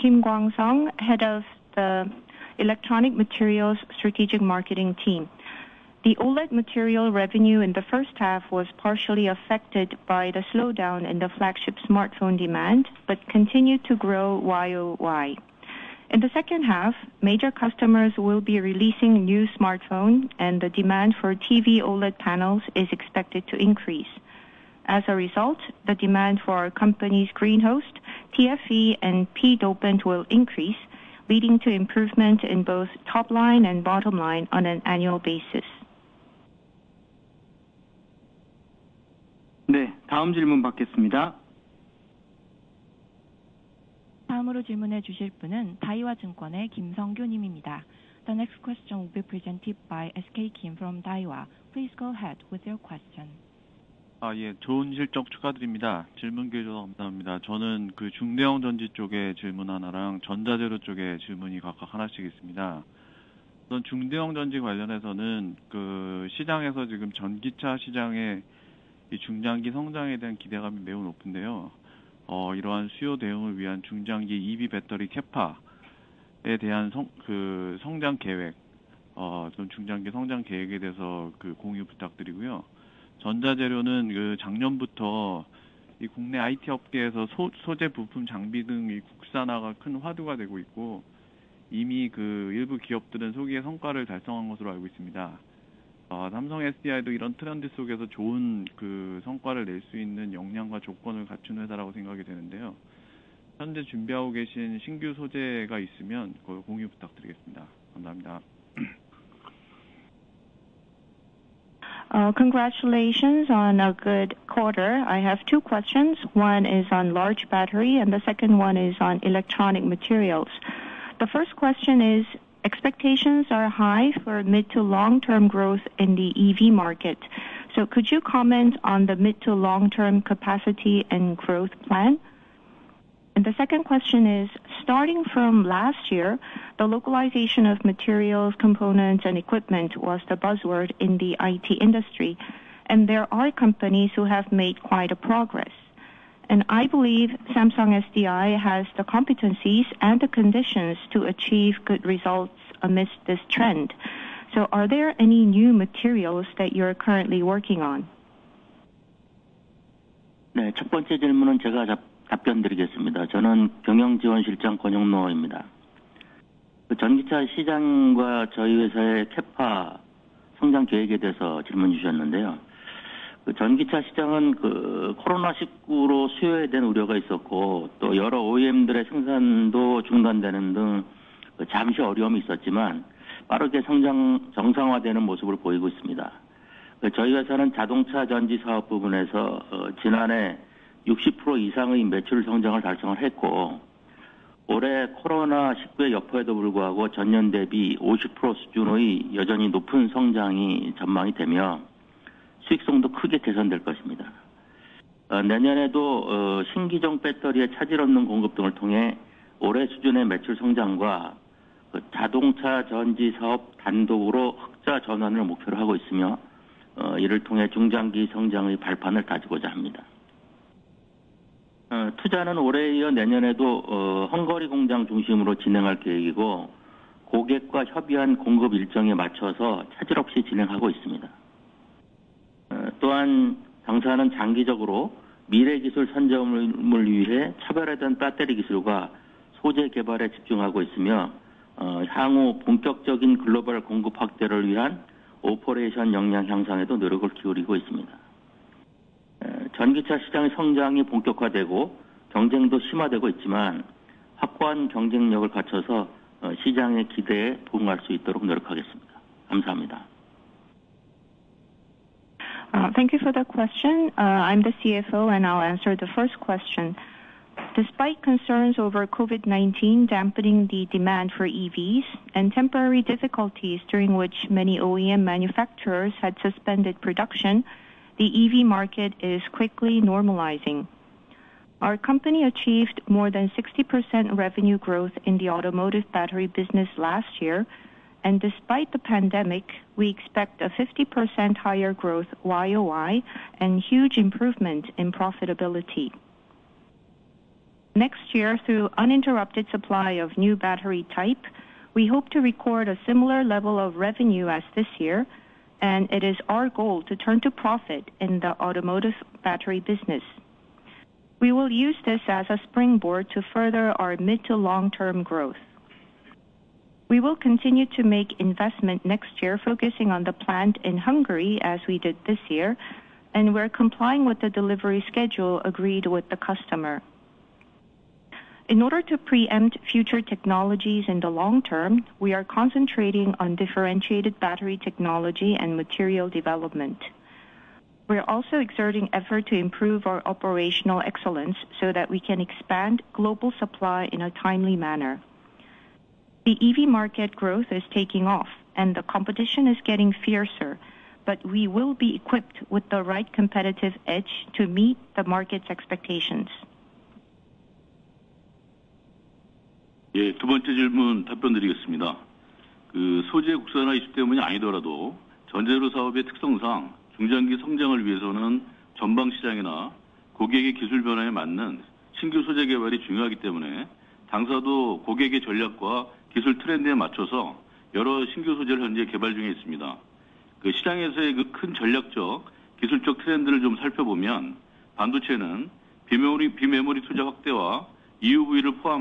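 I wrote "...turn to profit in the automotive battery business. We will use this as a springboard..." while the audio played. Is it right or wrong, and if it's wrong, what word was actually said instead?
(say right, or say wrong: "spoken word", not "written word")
right.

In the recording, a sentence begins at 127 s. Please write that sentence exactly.
So could you comment on the mid to long-term capacity and growth plan?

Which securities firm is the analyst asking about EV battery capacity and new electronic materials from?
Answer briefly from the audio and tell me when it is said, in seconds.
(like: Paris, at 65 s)
Daiwa, at 51 s.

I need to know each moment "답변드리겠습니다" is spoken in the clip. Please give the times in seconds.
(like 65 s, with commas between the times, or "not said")
162 s, 361 s.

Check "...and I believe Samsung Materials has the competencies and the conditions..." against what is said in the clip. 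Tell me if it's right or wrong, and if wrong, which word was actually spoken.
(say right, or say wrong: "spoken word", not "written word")
wrong: "SDI", not "Materials".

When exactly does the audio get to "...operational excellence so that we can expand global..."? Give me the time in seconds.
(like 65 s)
340 s.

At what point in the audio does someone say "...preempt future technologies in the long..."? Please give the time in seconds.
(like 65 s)
329 s.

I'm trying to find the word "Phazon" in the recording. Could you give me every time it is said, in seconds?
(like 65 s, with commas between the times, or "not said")
not said.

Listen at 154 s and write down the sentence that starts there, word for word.
So are there any new materials that you're currently working on?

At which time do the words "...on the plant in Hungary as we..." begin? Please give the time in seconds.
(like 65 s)
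320 s.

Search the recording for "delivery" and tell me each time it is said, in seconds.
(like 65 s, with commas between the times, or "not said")
324 s.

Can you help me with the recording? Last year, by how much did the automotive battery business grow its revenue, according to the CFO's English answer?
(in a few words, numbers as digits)
more than 60%.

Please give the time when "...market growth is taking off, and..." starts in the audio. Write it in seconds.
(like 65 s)
346 s.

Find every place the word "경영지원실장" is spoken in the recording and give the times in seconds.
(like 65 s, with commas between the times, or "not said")
163 s.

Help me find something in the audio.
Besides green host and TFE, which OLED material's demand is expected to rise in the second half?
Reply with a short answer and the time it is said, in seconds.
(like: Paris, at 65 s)
P-dopant, at 29 s.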